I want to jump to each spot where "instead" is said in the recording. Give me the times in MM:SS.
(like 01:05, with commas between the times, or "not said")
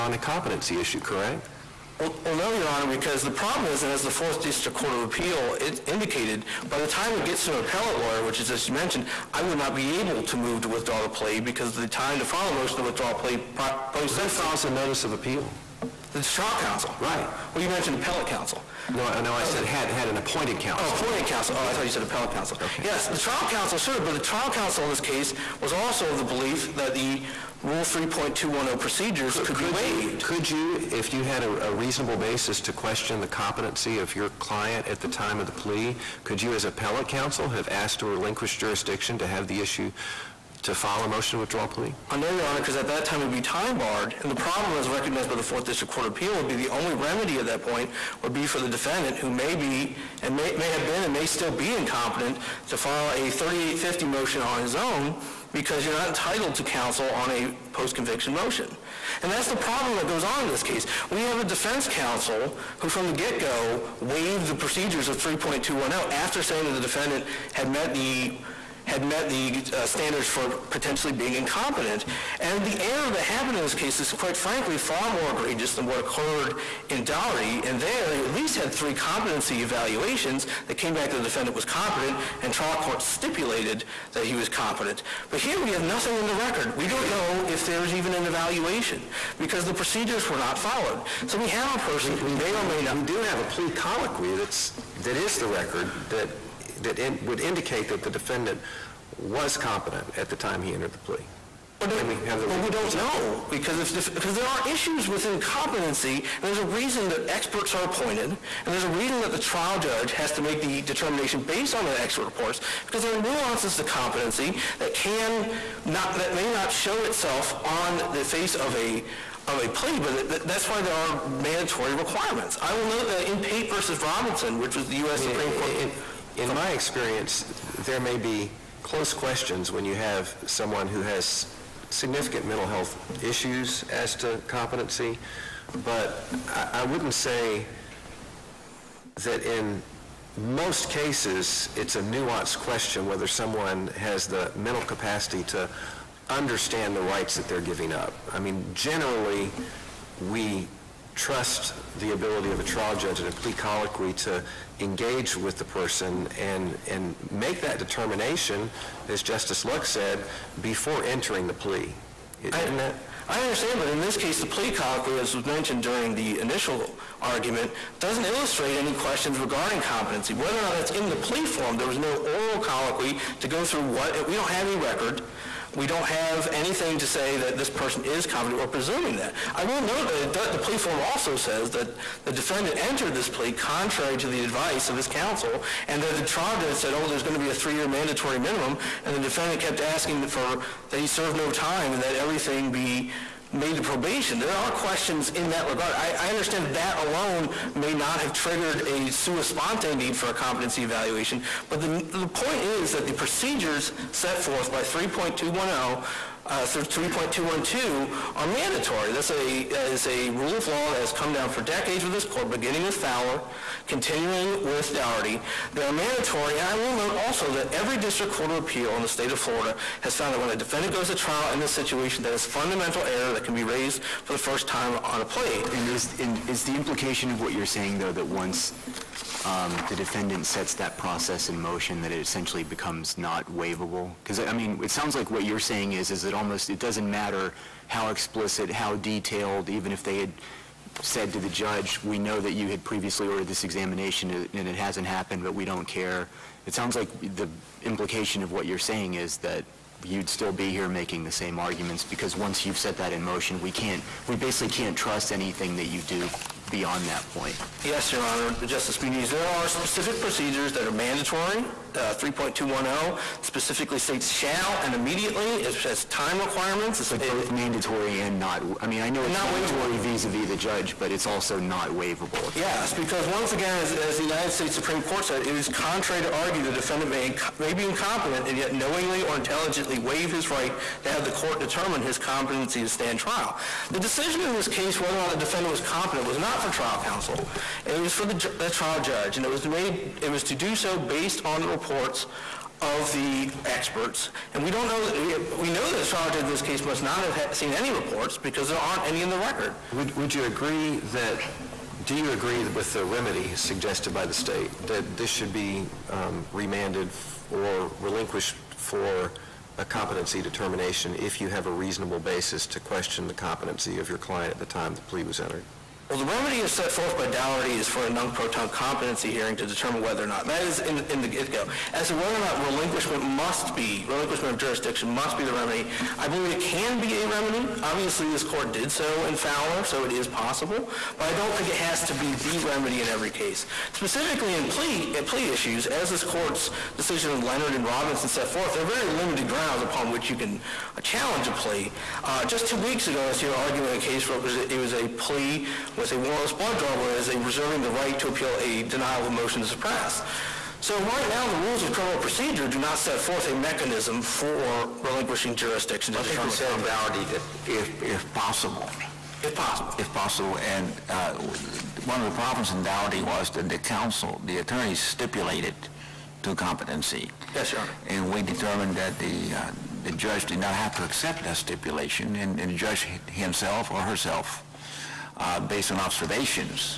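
not said.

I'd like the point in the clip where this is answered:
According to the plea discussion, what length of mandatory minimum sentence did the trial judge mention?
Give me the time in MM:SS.
03:07.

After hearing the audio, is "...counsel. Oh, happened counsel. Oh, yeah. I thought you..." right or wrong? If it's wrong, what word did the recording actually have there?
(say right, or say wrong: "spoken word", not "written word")
wrong: "appointed", not "happened".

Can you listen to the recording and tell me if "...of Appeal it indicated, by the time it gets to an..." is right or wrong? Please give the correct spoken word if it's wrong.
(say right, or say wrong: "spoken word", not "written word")
right.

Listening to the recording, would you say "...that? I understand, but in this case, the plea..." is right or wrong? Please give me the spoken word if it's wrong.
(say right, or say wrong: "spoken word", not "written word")
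right.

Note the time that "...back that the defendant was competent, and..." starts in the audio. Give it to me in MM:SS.
01:20.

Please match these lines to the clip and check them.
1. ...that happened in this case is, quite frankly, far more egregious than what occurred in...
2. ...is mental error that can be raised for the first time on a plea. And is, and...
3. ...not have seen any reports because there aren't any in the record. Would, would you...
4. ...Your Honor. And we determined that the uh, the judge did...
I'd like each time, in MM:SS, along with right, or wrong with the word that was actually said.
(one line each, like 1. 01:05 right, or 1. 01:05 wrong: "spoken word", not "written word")
1. 01:13 right
2. 03:42 wrong: "fundamental", not "mental"
3. 04:57 right
4. 06:07 right.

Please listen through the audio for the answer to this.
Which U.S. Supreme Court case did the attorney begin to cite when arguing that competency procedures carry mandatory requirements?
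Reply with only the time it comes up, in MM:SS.
02:03.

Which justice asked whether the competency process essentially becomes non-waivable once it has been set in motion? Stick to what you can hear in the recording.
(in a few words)
Justice Muniz.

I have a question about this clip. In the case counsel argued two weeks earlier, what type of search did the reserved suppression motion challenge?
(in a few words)
warrantless blood draw.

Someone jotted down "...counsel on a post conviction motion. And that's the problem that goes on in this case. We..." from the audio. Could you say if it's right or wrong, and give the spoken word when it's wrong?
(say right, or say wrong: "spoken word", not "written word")
right.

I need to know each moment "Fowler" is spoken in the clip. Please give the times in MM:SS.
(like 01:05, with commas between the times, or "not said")
03:32, 05:29.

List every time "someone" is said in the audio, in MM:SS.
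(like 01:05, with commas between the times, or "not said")
02:10, 02:23.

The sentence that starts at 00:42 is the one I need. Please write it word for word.
I know, Your Honor, because at that time it would be time barred.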